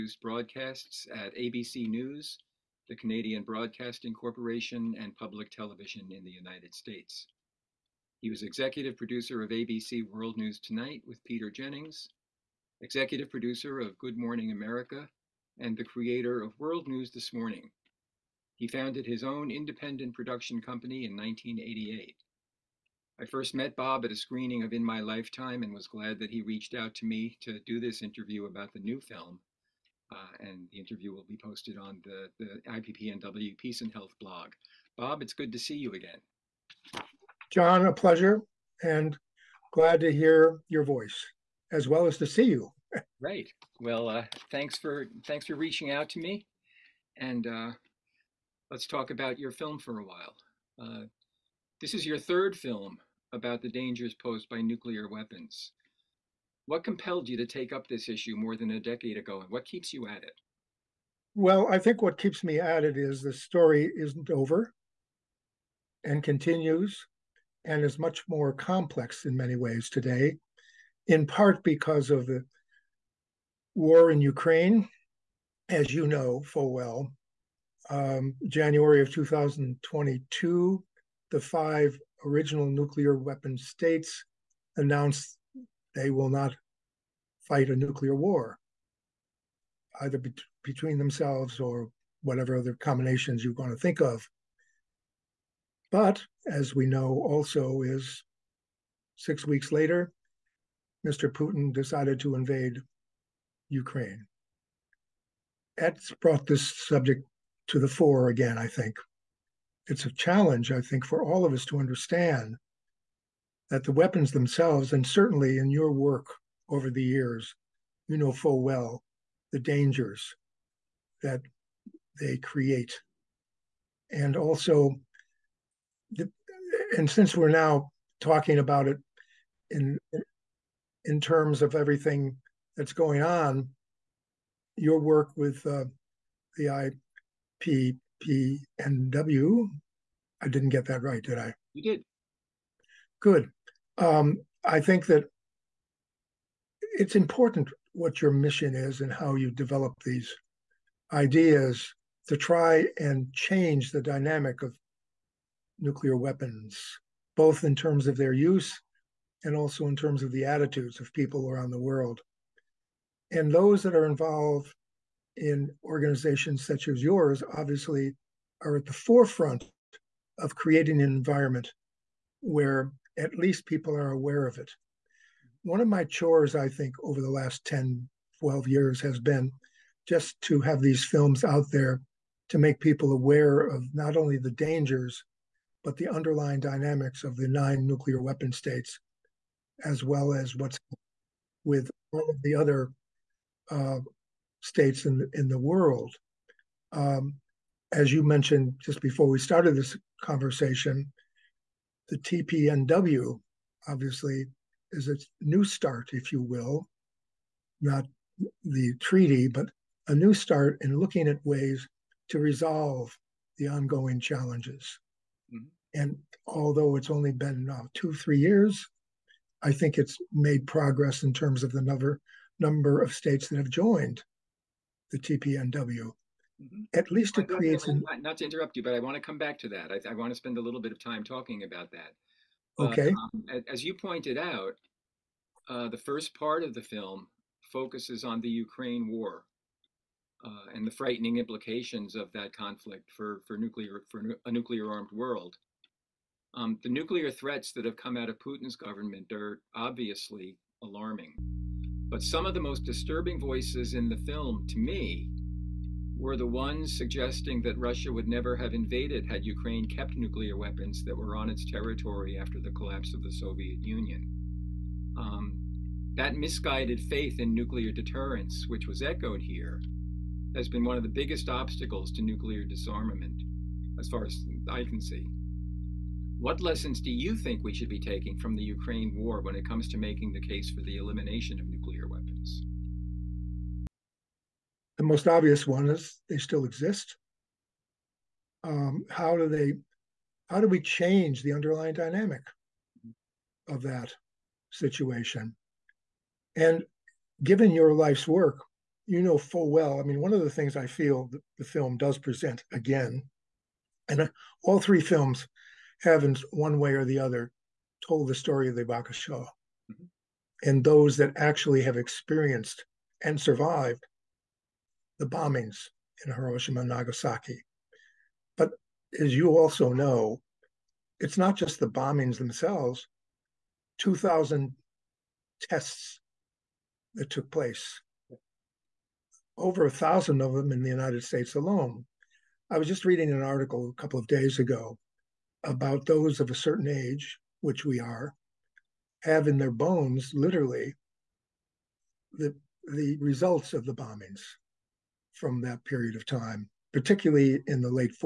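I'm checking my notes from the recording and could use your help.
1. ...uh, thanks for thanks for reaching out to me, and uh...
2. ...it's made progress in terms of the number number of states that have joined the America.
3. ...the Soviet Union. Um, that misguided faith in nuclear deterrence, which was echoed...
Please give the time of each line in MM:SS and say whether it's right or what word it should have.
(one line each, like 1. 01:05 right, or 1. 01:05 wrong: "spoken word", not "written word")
1. 00:44 right
2. 03:39 wrong: "TPNW", not "America"
3. 04:23 right.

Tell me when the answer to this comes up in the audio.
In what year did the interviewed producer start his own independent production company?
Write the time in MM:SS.
00:21.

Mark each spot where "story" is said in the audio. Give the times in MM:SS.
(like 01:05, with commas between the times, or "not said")
01:03, 05:08.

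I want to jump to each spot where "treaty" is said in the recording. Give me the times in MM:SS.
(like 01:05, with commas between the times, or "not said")
03:28.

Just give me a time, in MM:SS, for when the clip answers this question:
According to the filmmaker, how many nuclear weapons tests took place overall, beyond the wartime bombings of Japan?
05:23.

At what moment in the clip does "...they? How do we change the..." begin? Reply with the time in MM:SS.
04:49.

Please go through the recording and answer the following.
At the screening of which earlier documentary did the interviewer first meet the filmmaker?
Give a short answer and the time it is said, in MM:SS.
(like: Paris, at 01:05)
In My Lifetime, at 00:24.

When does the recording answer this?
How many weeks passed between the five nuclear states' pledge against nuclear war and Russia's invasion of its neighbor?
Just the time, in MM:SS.
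01:39.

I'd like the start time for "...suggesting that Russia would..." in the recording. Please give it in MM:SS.
04:16.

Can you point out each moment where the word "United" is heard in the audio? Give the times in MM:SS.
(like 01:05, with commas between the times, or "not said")
00:06, 05:30.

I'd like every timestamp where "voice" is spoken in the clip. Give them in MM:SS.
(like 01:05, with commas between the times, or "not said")
00:40, 04:13.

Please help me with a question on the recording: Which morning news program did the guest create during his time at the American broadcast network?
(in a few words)
World News This Morning.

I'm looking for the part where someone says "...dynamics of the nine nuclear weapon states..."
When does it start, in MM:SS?
03:06.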